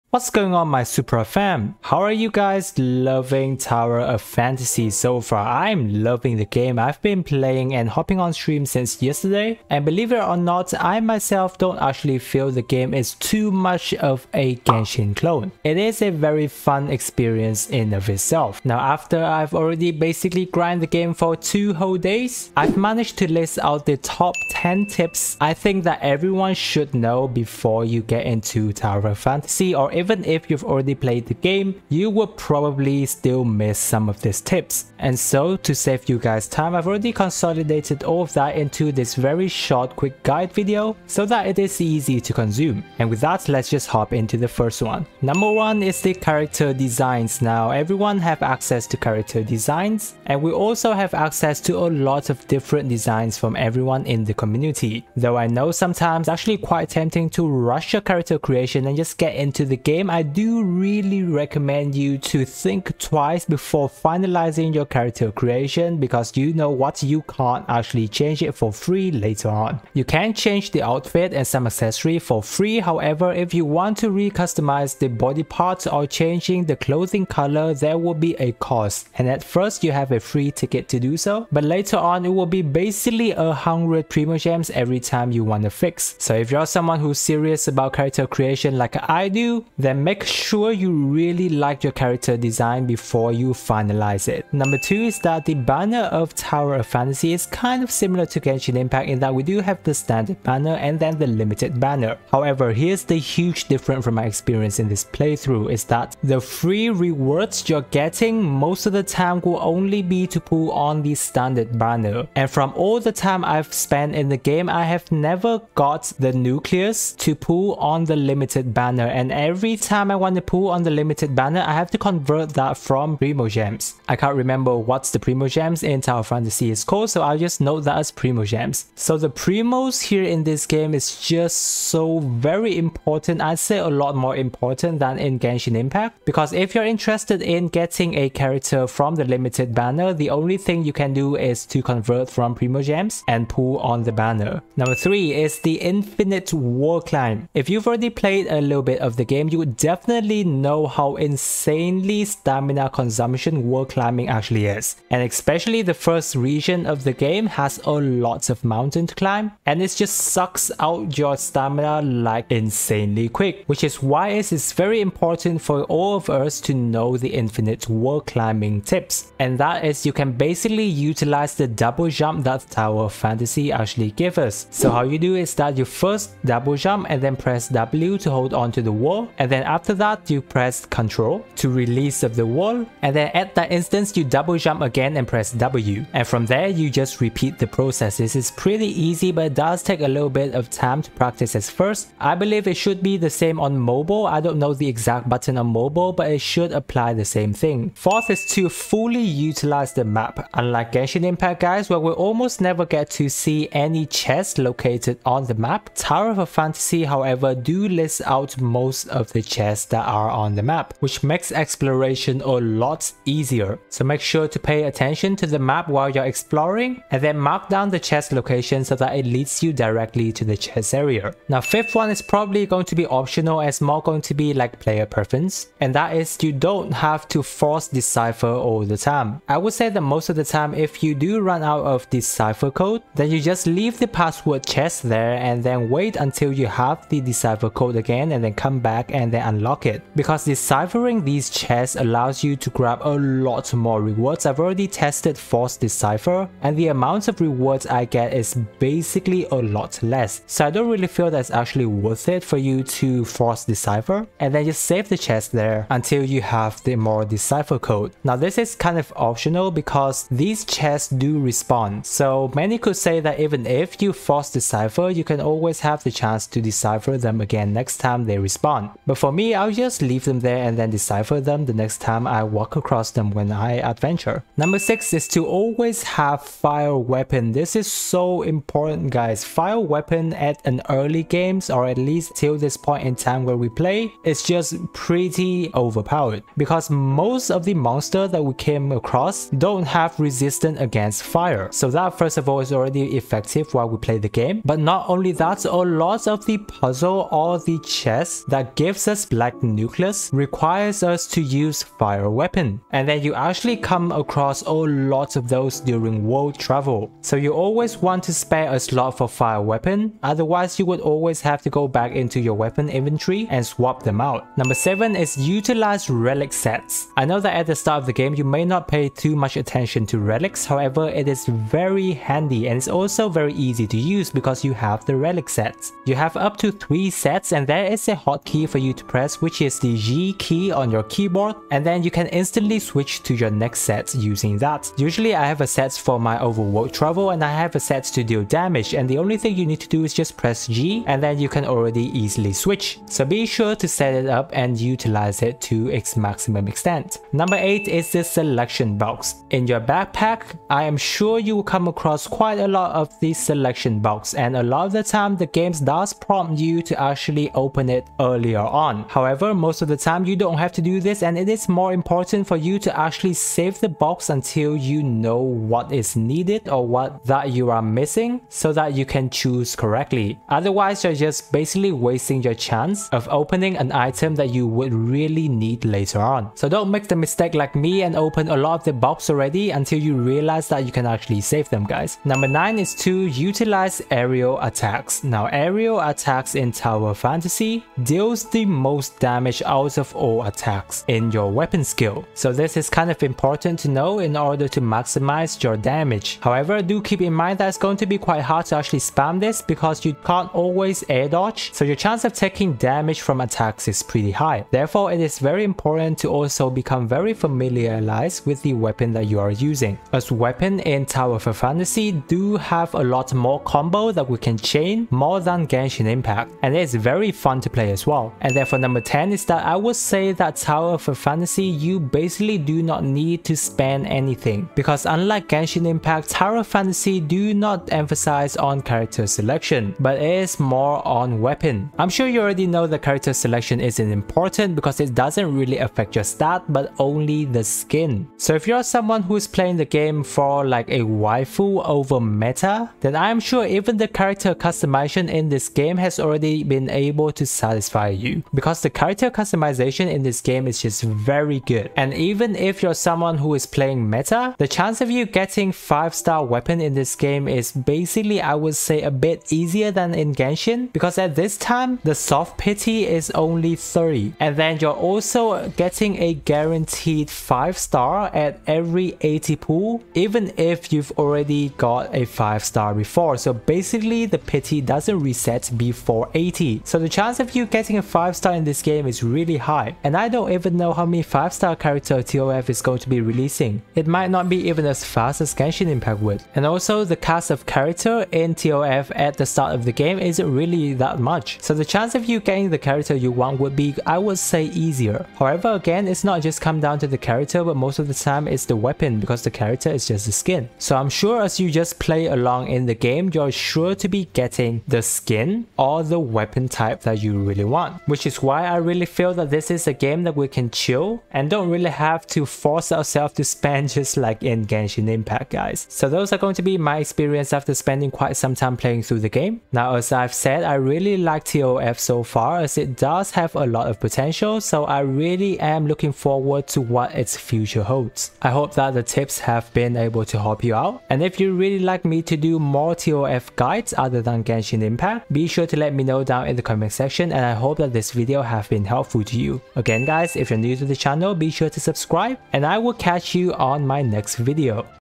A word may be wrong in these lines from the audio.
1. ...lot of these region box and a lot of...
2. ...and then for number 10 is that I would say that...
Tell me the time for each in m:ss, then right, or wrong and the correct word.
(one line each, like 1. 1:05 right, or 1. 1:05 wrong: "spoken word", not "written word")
1. 5:52 wrong: "selection", not "region"
2. 6:58 right.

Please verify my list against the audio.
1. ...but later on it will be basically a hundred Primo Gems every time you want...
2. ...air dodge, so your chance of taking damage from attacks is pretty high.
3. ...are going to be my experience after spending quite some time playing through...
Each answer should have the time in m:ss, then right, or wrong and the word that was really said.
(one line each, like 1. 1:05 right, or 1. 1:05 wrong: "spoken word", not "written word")
1. 1:21 right
2. 6:41 right
3. 8:36 right.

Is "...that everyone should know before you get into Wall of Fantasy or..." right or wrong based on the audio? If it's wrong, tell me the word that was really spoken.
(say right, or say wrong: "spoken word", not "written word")
wrong: "Tower", not "Wall".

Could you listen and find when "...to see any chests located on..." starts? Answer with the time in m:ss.
3:23.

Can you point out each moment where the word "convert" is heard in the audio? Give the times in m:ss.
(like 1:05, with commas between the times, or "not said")
2:01, 2:21.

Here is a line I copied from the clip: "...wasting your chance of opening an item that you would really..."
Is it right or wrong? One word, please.
right.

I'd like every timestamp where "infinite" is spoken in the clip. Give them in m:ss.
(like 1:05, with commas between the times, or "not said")
2:25, 2:47.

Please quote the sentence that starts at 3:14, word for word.
I don't know the exact button on mobile but it should apply the same thing.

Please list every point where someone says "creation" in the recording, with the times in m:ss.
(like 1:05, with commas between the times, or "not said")
0:58, 1:05, 1:28.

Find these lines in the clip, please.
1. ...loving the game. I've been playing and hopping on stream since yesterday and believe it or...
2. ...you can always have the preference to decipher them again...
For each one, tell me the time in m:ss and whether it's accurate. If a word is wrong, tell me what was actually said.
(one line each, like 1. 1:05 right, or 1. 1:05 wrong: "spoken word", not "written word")
1. 0:06 right
2. 4:25 wrong: "chance", not "preference".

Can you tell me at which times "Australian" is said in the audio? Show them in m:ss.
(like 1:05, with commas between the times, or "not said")
not said.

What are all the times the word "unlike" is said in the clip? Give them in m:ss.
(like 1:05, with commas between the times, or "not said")
3:20, 7:05.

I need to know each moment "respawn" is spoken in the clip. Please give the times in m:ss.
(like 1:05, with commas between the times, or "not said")
4:21, 4:28.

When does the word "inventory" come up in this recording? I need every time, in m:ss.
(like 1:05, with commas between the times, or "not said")
5:12.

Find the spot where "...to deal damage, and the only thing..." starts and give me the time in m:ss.
5:38.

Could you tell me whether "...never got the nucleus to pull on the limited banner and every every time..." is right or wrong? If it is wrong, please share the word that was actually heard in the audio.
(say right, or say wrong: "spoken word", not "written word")
right.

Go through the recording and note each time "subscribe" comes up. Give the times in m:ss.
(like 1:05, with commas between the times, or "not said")
9:01.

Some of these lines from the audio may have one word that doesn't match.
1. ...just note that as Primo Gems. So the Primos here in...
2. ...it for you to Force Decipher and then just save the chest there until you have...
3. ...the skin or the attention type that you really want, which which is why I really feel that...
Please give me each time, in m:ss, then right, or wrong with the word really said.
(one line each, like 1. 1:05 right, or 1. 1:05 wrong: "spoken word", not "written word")
1. 2:07 right
2. 4:12 right
3. 8:24 wrong: "weapon", not "attention".